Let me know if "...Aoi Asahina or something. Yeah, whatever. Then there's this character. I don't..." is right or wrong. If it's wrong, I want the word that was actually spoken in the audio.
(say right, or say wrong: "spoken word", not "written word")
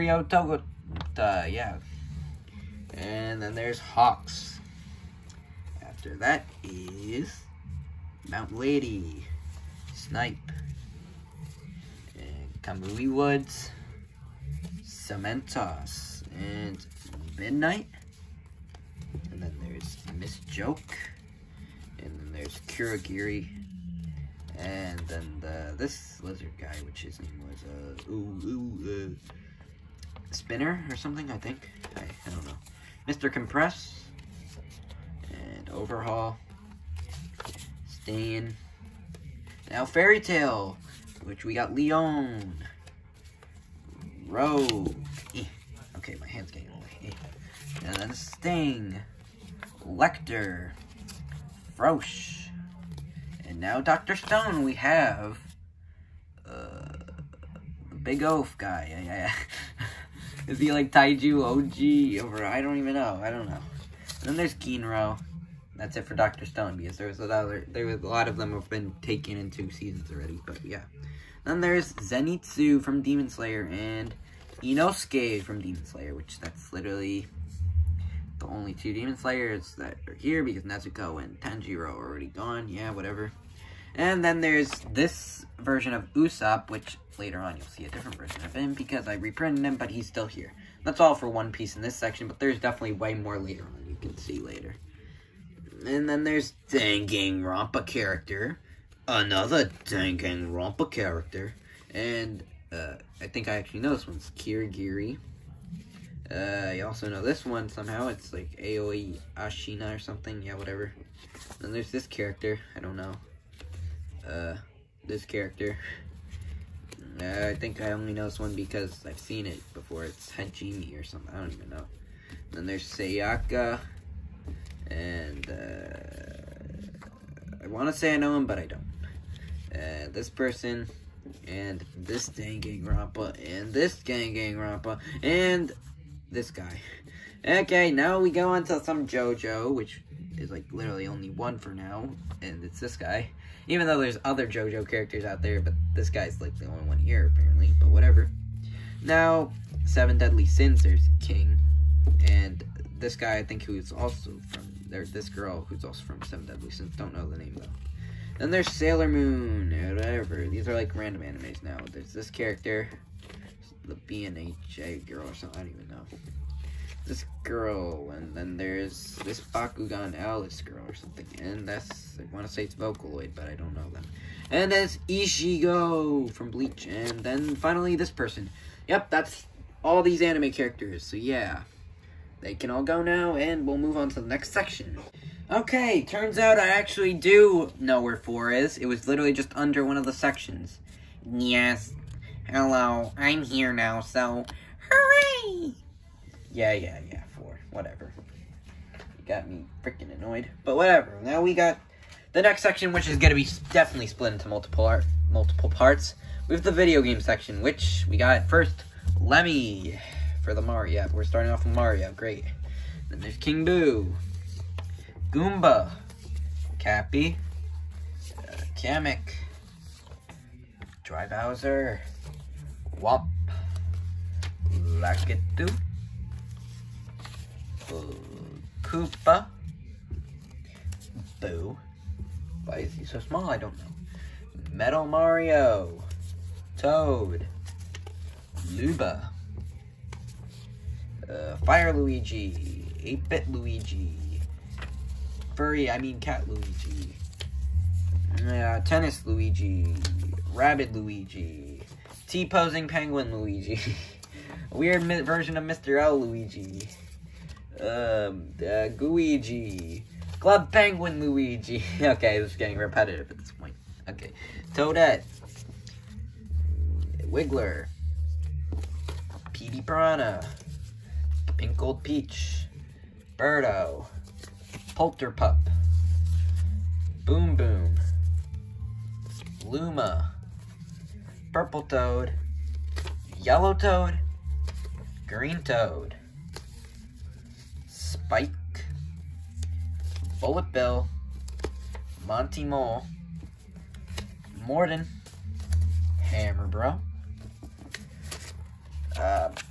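right.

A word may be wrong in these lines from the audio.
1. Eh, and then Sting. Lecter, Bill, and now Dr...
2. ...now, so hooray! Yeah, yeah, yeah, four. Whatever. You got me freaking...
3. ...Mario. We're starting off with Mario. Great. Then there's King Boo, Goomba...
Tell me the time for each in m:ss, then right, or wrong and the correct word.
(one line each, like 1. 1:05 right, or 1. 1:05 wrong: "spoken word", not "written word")
1. 0:47 wrong: "Frosch", not "Bill"
2. 3:13 right
3. 3:30 right.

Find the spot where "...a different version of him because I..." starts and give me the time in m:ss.
1:27.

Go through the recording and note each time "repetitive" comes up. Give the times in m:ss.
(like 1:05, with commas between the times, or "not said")
4:22.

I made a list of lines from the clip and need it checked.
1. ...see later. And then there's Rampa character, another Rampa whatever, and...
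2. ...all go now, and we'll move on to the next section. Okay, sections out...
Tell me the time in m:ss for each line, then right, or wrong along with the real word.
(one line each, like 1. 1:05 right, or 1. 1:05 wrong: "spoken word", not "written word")
1. 1:34 wrong: "character", not "whatever"
2. 3:02 wrong: "turns", not "sections".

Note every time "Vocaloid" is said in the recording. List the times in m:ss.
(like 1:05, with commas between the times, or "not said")
2:52.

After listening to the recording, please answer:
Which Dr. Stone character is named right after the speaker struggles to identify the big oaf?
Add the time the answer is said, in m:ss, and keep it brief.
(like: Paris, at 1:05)
Kinro, at 1:04.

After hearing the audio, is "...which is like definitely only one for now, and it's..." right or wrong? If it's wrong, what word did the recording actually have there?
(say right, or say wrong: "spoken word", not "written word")
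wrong: "literally", not "definitely".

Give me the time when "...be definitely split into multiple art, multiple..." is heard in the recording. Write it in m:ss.
3:23.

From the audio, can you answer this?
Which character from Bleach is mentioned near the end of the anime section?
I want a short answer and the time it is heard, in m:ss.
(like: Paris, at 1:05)
Ichigo, at 2:55.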